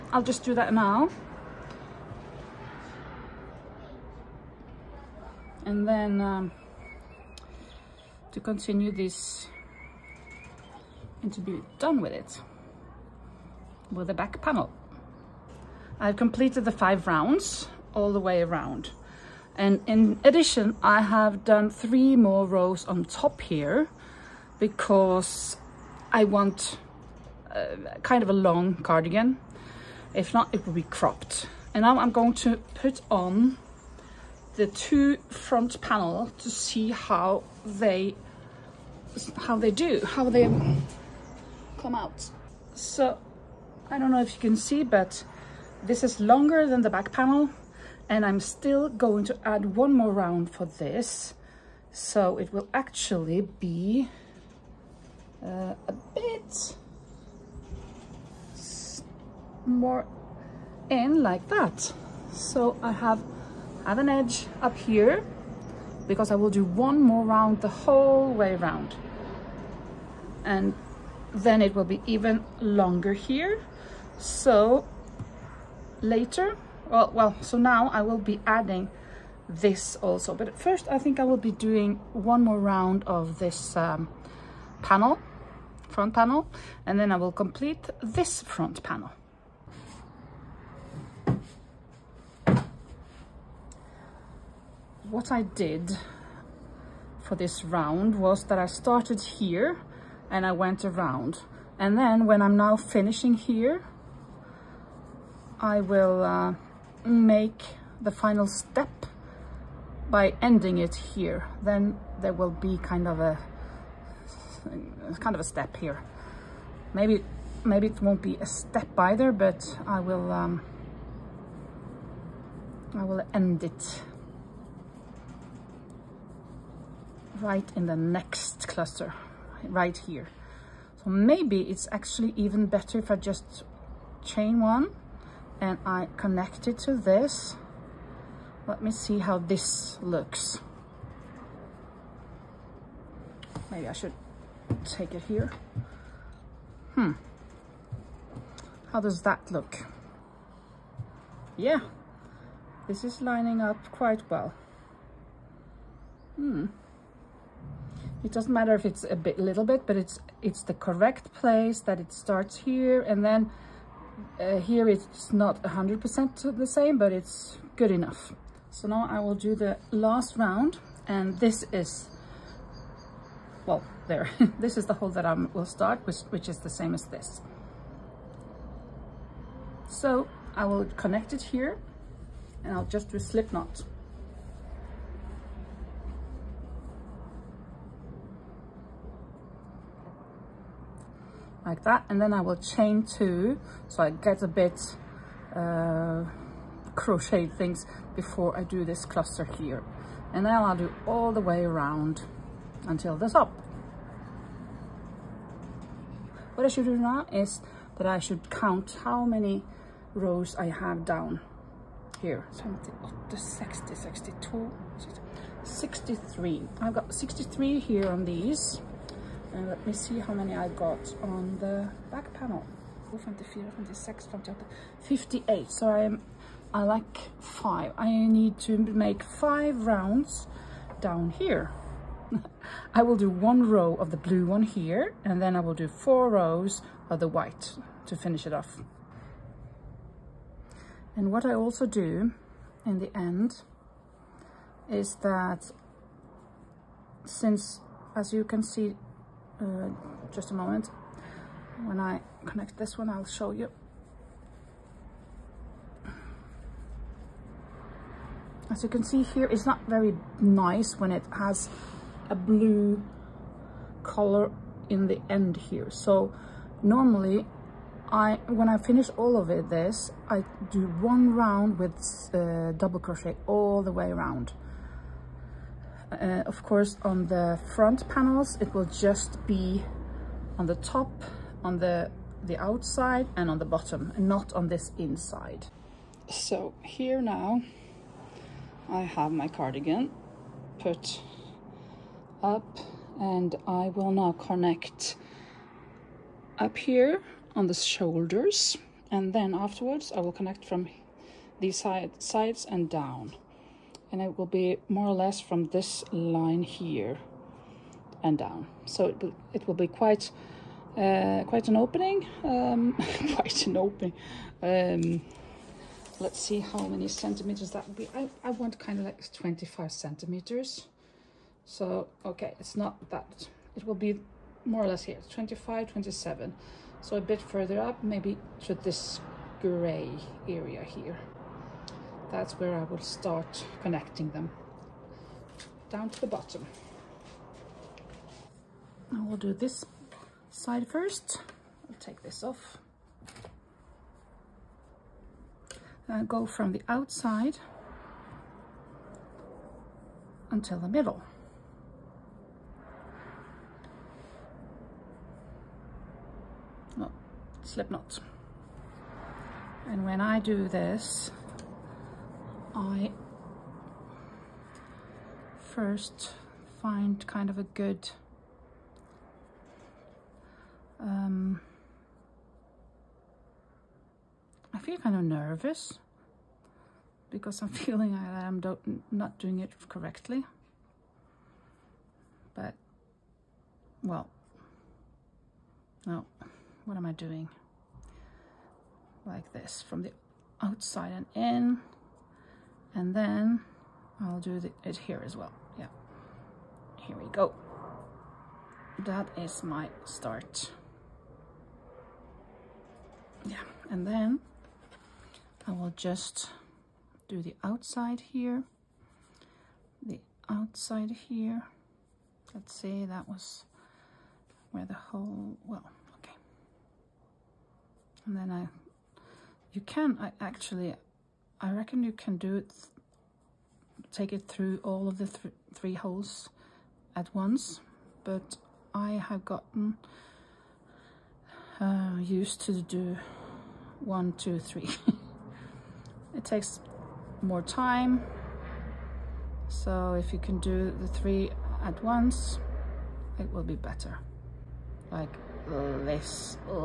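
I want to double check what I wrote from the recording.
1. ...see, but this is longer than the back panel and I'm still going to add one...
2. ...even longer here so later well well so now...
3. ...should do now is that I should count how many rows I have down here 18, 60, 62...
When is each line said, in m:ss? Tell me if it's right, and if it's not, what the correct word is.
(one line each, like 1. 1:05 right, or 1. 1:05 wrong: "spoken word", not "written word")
1. 0:44 right
2. 1:12 right
3. 3:26 wrong: "78", not "18".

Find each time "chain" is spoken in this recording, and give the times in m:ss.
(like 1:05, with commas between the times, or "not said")
2:14, 3:12.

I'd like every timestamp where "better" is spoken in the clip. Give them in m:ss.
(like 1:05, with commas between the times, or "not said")
2:12, 7:23.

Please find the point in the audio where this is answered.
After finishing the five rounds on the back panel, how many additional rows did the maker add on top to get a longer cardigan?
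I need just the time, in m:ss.
0:21.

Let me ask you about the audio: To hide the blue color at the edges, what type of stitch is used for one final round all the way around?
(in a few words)
Double crochet.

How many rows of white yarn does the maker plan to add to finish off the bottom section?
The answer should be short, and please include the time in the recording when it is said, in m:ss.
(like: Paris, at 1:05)
4, at 3:55.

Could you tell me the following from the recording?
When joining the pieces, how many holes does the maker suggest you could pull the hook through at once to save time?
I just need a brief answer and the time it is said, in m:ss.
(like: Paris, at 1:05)
3, at 7:05.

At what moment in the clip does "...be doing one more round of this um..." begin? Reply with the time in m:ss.
1:21.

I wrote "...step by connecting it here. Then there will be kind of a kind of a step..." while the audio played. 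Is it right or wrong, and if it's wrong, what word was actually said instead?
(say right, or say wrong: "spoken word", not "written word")
wrong: "ending", not "connecting".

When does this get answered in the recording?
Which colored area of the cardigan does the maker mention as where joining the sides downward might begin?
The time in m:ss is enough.
5:29.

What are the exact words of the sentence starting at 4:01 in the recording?
And what I also do in the end is that since, as you can see, uh, just a moment.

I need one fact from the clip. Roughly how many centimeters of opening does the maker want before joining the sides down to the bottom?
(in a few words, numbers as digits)
25.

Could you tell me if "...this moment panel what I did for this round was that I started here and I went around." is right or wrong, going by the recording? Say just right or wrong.
wrong.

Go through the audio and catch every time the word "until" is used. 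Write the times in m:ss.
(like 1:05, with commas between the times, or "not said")
3:22, 5:50.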